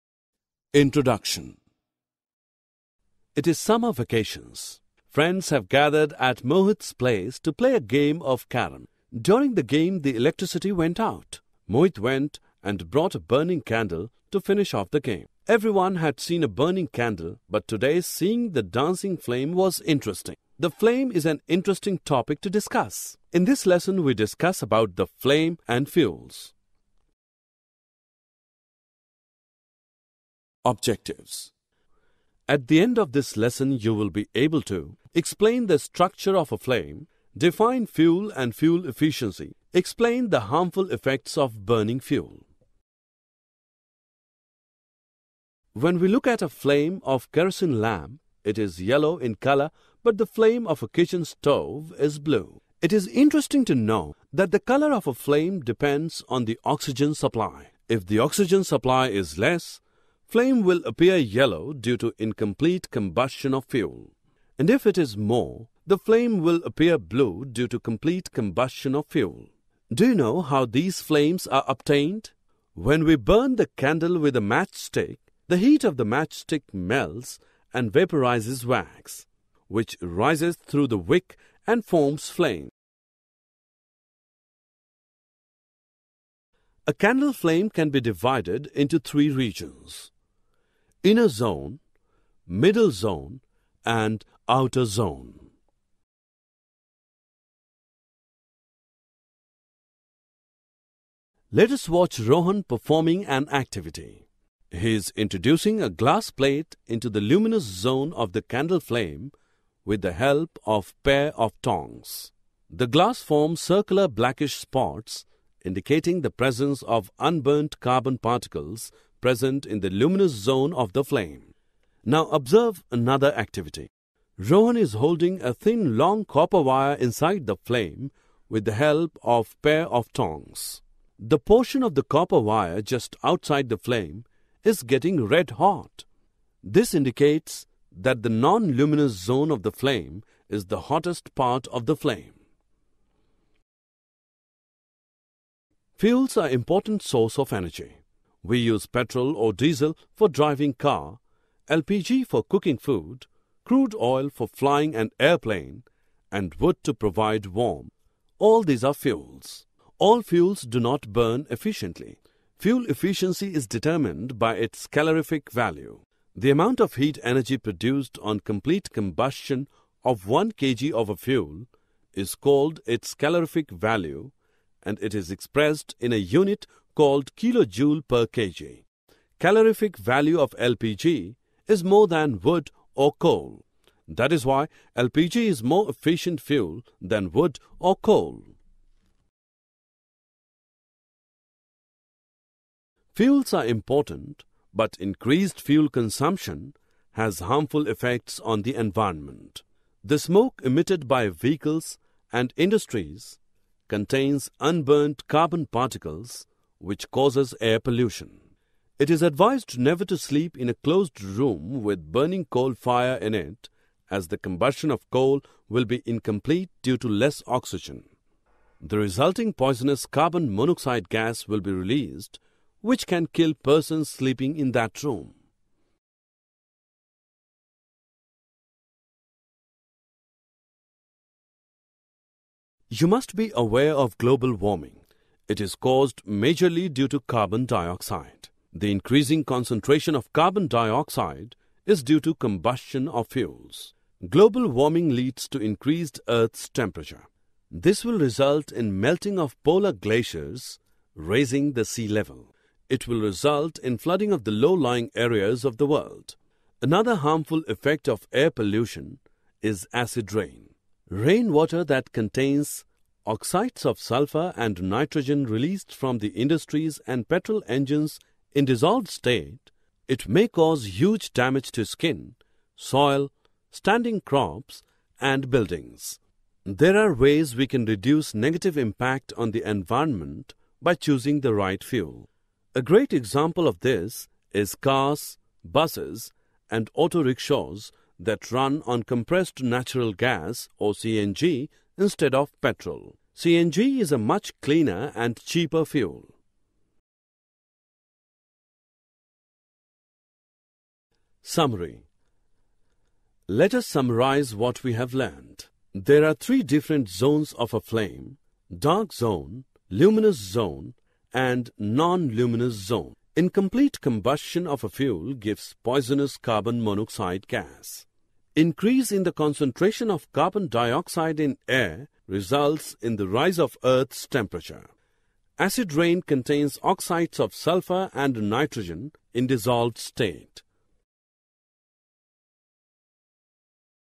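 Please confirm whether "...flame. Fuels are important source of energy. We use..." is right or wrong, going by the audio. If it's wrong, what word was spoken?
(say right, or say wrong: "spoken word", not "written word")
right.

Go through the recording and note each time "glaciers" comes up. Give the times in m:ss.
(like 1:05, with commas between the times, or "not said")
4:09.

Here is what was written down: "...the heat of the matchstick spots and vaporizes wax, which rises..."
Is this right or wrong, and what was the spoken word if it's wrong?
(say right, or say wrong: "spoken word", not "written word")
wrong: "melts", not "spots".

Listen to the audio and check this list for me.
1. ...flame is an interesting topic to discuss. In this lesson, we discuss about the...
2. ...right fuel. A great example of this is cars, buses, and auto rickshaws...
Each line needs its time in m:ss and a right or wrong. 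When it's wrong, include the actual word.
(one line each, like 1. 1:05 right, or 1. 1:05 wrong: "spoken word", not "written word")
1. 0:20 right
2. 4:41 right.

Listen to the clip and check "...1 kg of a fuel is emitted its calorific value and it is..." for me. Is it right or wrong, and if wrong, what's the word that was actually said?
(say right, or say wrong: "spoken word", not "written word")
wrong: "called", not "emitted".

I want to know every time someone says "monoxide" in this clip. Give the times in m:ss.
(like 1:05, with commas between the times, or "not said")
3:40, 5:16.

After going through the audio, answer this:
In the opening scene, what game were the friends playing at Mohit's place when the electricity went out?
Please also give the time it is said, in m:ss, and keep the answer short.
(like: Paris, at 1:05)
Carom, at 0:08.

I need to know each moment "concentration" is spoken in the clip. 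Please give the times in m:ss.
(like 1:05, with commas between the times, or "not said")
3:59, 5:19.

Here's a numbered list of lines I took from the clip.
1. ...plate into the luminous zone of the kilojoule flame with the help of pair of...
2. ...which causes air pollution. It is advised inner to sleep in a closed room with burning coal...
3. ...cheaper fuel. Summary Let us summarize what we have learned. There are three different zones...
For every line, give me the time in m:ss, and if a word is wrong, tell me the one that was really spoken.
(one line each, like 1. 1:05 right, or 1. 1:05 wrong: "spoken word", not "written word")
1. 1:46 wrong: "candle", not "kilojoule"
2. 3:26 wrong: "never", not "inner"
3. 4:55 right.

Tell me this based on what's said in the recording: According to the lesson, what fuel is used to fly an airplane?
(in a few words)
Crude oil.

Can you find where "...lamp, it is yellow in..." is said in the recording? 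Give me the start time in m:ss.
0:47.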